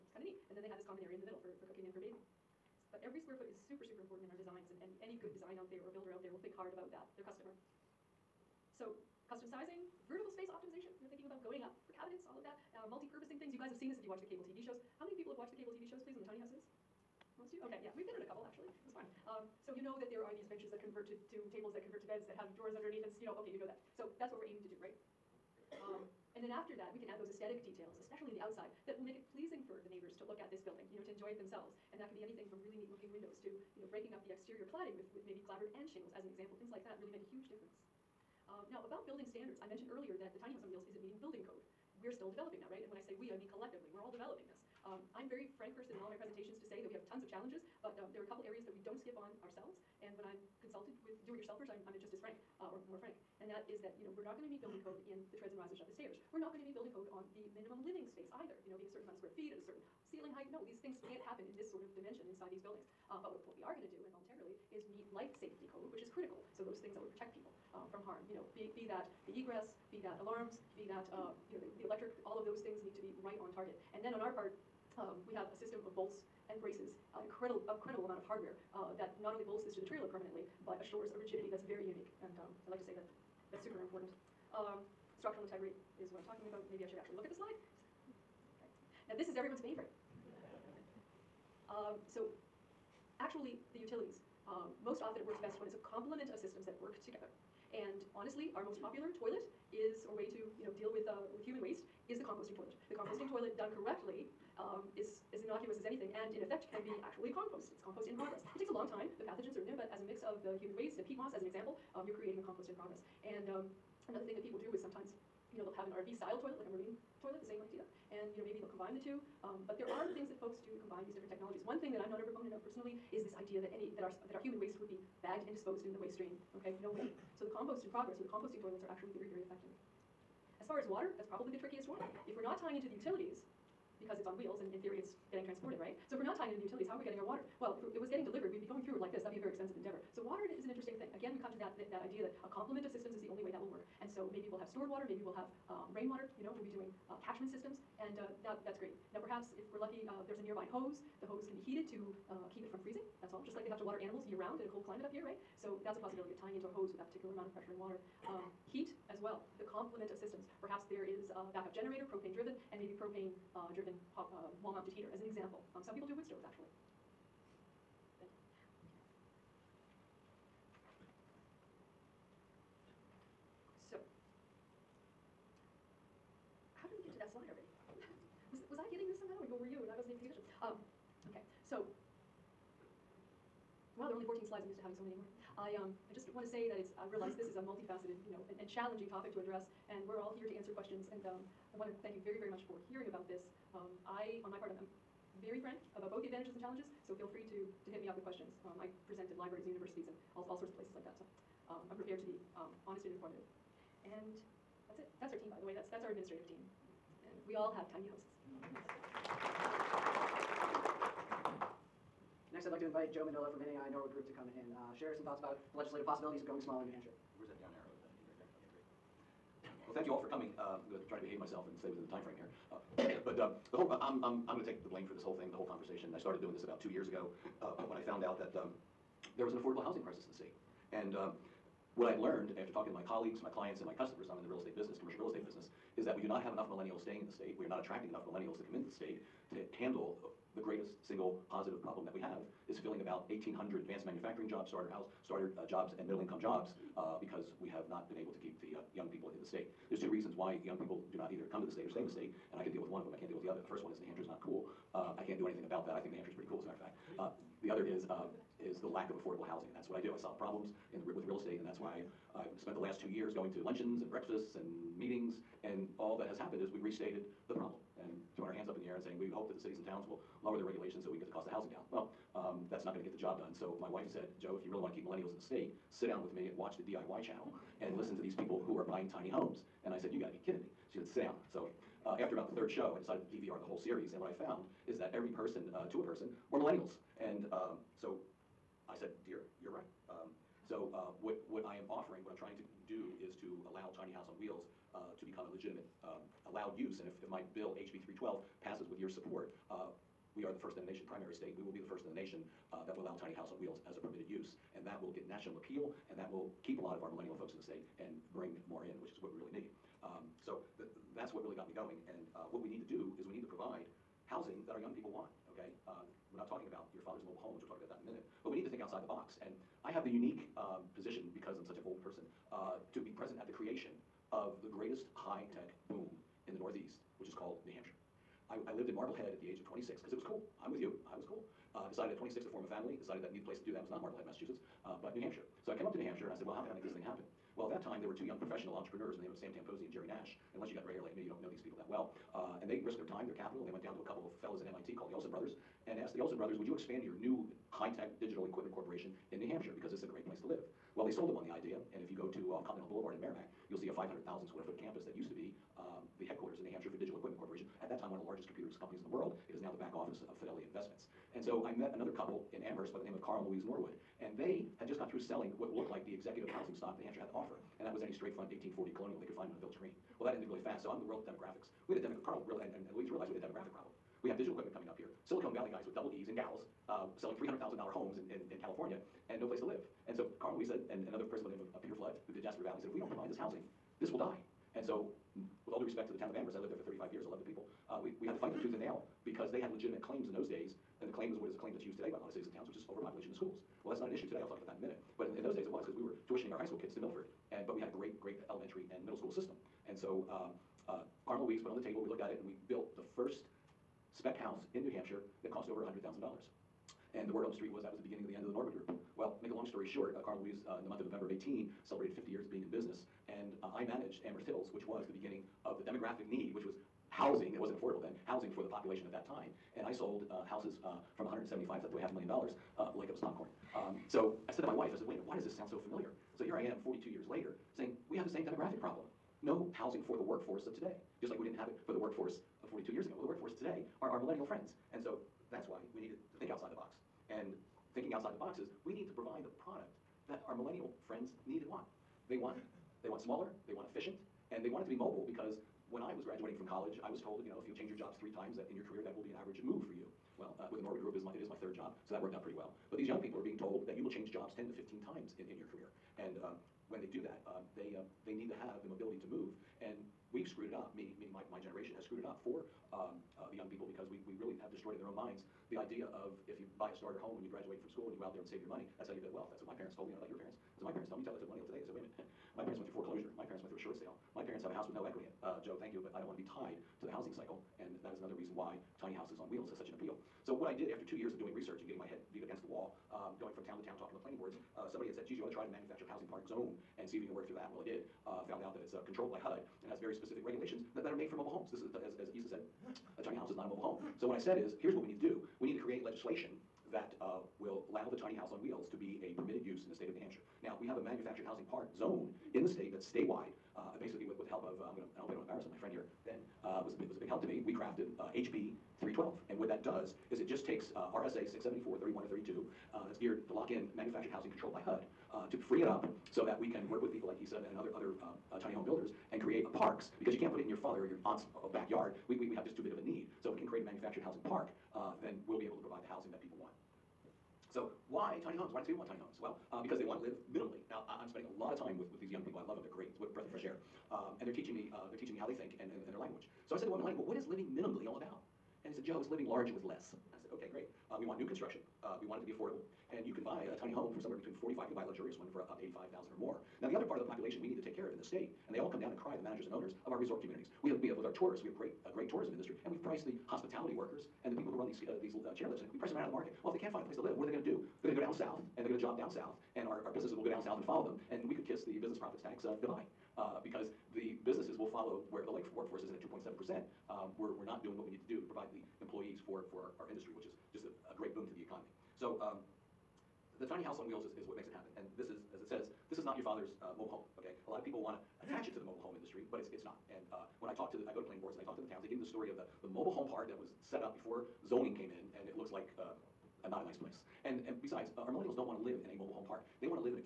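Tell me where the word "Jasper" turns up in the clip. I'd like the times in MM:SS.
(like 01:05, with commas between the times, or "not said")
06:22.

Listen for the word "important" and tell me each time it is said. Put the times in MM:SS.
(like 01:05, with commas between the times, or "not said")
00:04, 01:23.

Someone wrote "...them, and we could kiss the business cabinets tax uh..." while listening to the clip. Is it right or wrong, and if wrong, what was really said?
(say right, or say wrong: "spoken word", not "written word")
wrong: "profits", not "cabinets".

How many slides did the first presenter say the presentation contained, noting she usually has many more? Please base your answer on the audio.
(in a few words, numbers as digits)
14.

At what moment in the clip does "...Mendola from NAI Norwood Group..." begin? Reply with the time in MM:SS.
03:33.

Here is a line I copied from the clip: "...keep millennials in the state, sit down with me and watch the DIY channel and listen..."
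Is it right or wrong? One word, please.
right.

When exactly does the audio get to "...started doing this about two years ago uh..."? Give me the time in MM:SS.
03:46.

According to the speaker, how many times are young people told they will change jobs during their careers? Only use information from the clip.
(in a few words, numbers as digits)
10 to 15.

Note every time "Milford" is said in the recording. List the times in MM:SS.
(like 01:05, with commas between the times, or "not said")
06:37.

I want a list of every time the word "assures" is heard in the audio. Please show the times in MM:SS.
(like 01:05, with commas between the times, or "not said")
01:20.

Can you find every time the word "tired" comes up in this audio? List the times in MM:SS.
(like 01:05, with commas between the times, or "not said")
not said.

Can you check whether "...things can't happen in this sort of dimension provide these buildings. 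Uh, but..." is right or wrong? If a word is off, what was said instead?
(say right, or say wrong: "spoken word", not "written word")
wrong: "inside", not "provide".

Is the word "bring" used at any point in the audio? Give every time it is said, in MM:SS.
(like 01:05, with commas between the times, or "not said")
05:08.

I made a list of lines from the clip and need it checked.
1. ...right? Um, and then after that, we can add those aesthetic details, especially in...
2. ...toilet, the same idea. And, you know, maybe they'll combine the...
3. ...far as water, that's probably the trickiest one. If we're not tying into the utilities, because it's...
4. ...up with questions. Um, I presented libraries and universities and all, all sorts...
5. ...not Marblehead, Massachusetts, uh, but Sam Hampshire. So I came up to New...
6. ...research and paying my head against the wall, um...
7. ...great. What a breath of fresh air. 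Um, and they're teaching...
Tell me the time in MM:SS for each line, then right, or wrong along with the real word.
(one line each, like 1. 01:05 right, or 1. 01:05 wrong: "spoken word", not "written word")
1. 00:24 right
2. 01:57 right
3. 02:10 right
4. 03:18 right
5. 05:33 wrong: "New", not "Sam"
6. 08:01 wrong: "getting", not "paying"
7. 08:52 right.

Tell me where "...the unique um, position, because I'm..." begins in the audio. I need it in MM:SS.
05:20.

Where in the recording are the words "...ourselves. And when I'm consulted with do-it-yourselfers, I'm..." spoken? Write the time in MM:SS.
00:49.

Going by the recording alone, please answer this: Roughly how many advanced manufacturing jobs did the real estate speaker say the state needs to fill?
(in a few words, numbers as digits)
1,800.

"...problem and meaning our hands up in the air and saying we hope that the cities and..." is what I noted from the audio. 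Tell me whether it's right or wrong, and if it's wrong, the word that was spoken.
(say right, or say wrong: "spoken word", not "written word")
wrong: "throwing", not "meaning".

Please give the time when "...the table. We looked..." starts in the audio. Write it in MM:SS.
06:41.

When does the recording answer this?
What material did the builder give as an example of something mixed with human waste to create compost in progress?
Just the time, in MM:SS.
01:51.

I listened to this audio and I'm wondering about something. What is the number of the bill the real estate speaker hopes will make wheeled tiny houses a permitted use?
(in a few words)
HB 312.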